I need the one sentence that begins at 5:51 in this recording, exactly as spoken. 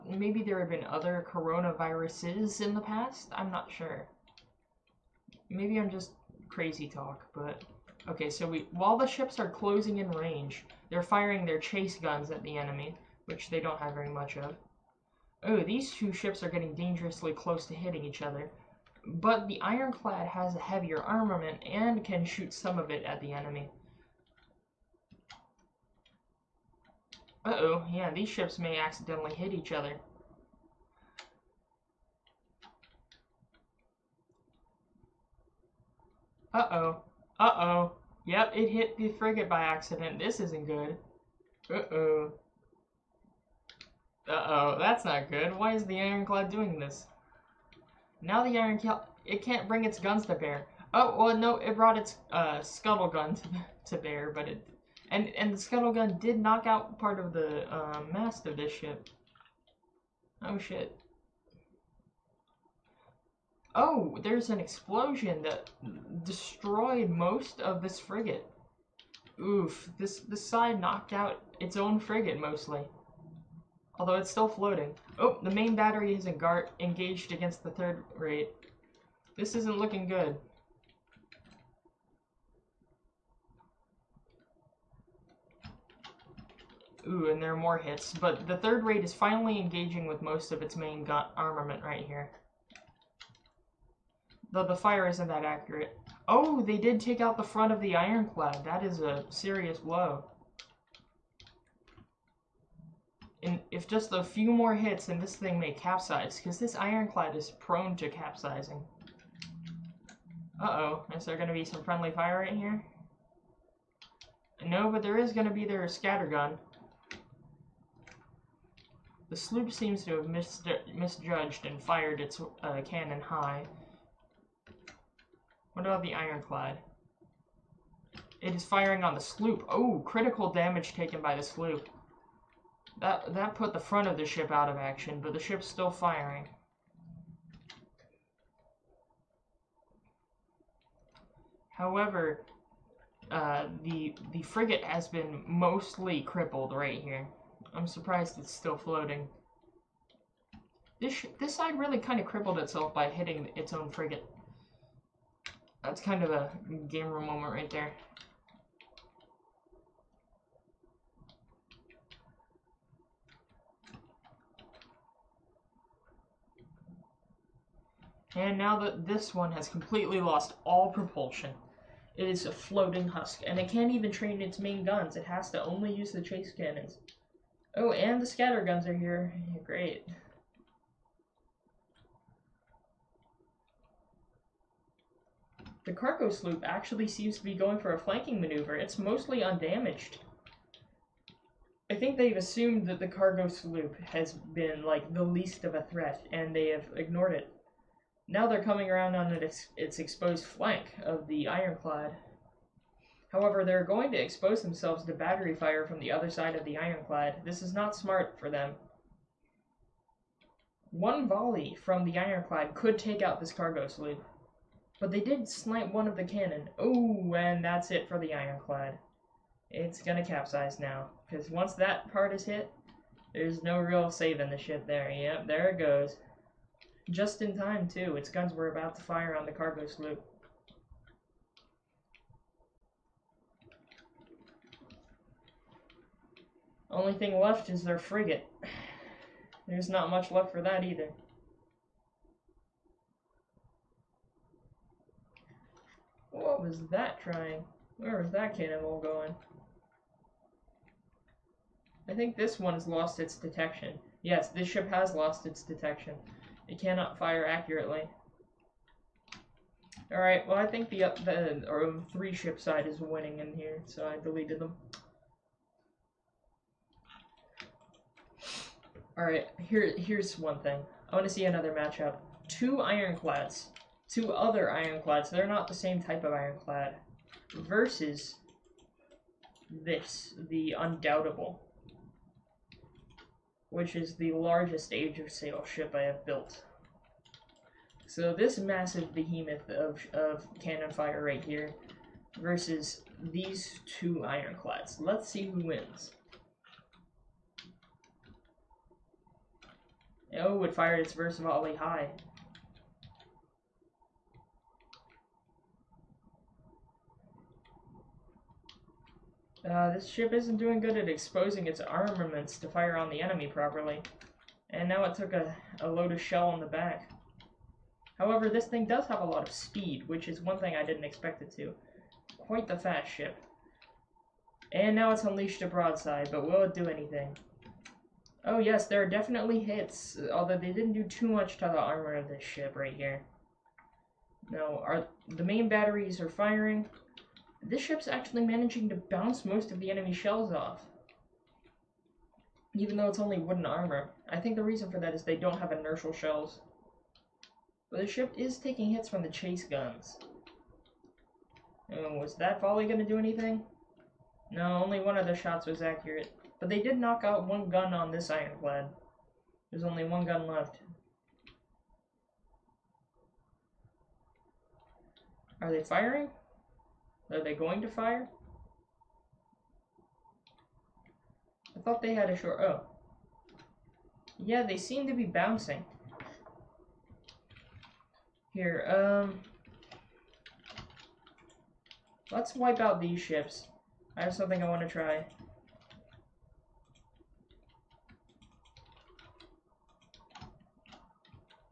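And was that volley going to do anything?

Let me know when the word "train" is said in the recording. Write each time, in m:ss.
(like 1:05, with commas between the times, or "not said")
2:54.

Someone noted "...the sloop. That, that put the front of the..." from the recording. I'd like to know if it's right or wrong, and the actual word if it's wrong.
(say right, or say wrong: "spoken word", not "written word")
right.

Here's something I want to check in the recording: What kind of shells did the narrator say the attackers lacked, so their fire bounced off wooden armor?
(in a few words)
Inertial shells.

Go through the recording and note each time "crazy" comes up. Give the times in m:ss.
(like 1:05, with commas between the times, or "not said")
0:06.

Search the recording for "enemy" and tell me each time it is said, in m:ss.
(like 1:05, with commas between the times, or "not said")
0:12, 0:23, 5:13, 5:39.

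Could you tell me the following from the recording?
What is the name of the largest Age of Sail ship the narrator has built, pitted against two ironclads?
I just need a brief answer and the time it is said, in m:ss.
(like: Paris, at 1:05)
The Undoubtable, at 4:40.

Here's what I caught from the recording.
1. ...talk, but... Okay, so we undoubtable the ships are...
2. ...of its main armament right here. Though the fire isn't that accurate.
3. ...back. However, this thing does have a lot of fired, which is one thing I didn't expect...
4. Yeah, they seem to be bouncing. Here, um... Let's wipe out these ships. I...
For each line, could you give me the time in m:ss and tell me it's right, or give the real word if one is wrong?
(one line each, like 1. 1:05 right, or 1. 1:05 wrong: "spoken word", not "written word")
1. 0:06 wrong: "while", not "undoubtable"
2. 1:30 right
3. 5:16 wrong: "speed", not "fired"
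4. 6:14 right.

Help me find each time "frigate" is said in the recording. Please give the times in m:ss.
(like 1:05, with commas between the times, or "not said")
0:39, 1:07, 1:11, 2:24, 2:33, 3:57.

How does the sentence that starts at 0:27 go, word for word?
Uh-oh, yeah, these ships may accidentally hit each other.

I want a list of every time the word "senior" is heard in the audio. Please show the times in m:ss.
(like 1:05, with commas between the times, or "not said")
not said.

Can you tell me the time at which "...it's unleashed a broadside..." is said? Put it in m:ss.
5:25.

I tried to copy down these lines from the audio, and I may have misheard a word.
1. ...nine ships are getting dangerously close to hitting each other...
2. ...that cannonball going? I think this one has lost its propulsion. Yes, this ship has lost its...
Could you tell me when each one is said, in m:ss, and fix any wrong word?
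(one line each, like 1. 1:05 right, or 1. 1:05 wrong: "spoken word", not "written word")
1. 0:15 wrong: "two", not "nine"
2. 4:08 wrong: "detection", not "propulsion".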